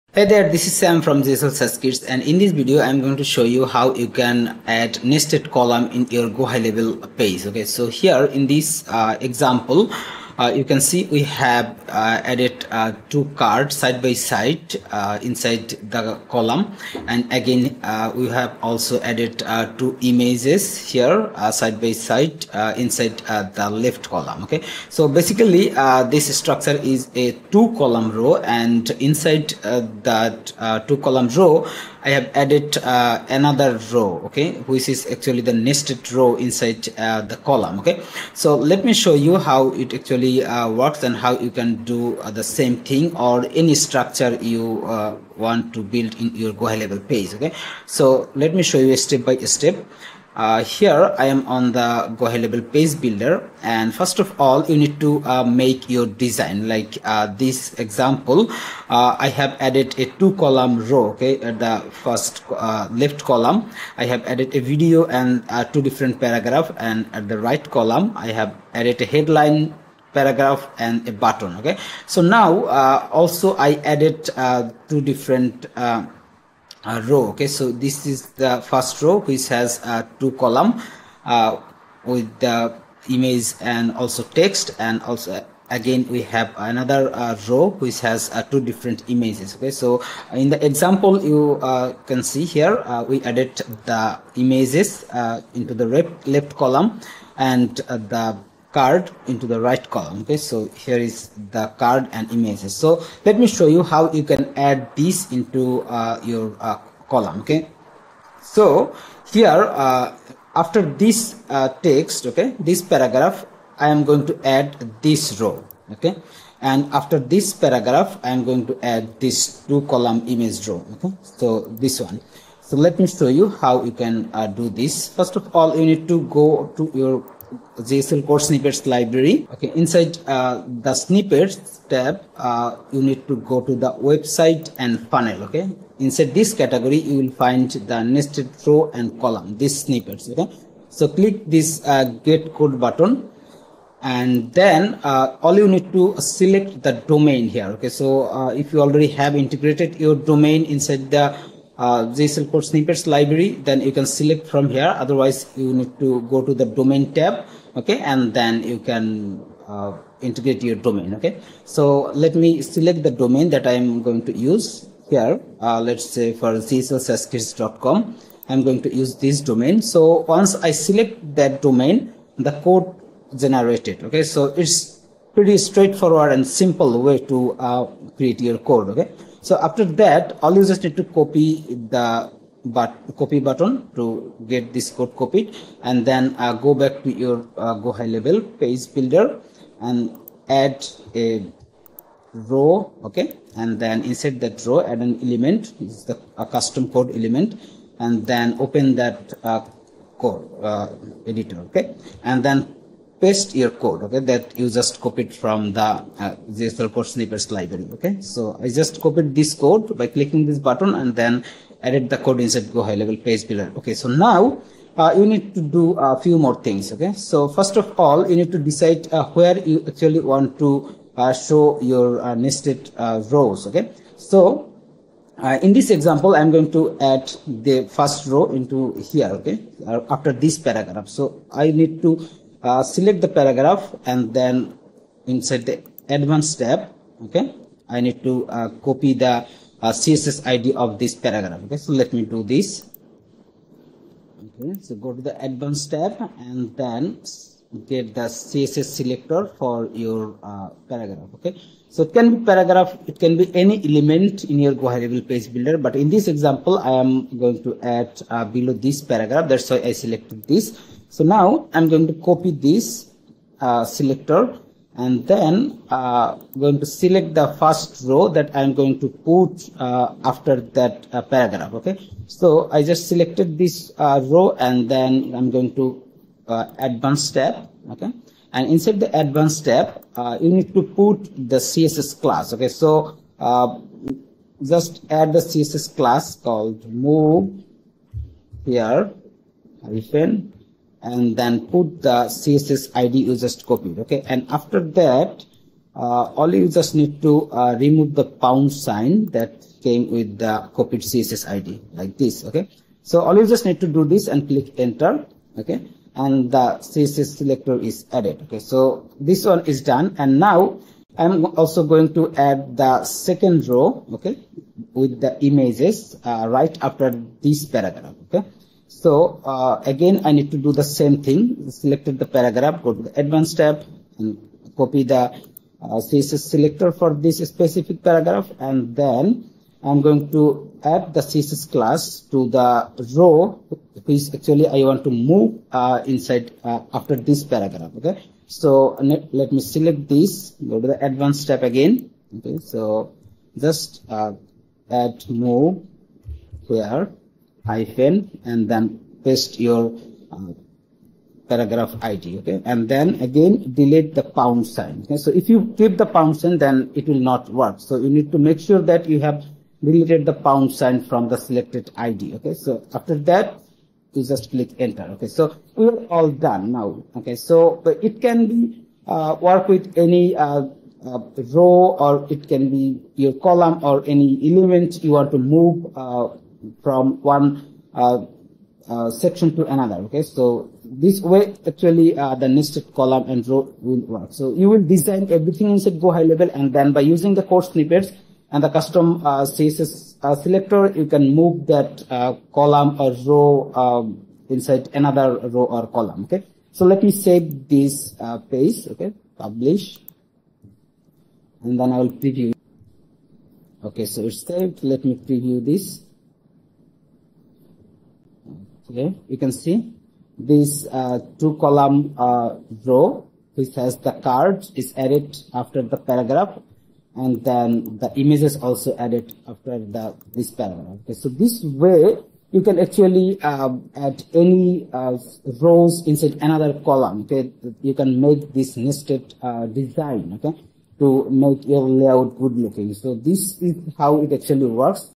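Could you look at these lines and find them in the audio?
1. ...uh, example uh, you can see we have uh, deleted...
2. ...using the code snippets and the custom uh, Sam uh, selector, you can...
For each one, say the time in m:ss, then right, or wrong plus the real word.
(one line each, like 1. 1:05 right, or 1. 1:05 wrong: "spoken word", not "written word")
1. 0:08 wrong: "added", not "deleted"
2. 6:27 wrong: "CSS", not "Sam".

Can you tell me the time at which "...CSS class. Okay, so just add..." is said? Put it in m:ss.
4:41.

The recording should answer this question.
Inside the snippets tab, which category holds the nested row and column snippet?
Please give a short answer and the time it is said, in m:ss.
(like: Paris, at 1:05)
website and funnel, at 2:13.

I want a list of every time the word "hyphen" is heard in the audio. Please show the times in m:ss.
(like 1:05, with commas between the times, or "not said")
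4:49, 5:47.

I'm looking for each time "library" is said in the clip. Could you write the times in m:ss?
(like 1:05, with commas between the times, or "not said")
2:08, 2:33, 3:27.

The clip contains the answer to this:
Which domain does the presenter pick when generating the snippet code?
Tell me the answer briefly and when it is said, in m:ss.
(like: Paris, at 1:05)
ghlsaaskits.com, at 2:46.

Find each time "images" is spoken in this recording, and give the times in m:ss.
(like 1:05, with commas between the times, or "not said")
0:20, 1:23, 1:29, 1:34, 1:42, 2:00, 5:15, 6:58.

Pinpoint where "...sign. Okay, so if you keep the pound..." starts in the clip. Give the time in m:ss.
5:54.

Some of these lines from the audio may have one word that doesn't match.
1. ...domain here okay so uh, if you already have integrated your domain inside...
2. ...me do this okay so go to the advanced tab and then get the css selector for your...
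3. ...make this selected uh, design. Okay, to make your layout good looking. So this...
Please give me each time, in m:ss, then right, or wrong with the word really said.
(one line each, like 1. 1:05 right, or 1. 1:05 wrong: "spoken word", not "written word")
1. 2:27 right
2. 4:02 right
3. 7:08 wrong: "nested", not "selected".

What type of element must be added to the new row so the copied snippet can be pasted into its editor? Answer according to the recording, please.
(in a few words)
custom code element.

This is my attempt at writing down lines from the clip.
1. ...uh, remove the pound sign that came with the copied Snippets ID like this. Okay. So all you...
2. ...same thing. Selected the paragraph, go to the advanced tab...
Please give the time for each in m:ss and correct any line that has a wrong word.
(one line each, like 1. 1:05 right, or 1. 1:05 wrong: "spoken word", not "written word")
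1. 4:57 wrong: "CSS", not "Snippets"
2. 5:20 right.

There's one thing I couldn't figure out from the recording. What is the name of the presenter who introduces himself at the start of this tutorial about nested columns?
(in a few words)
Sam.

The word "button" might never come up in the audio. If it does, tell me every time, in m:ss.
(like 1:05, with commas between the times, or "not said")
1:11, 2:22, 3:03, 3:30.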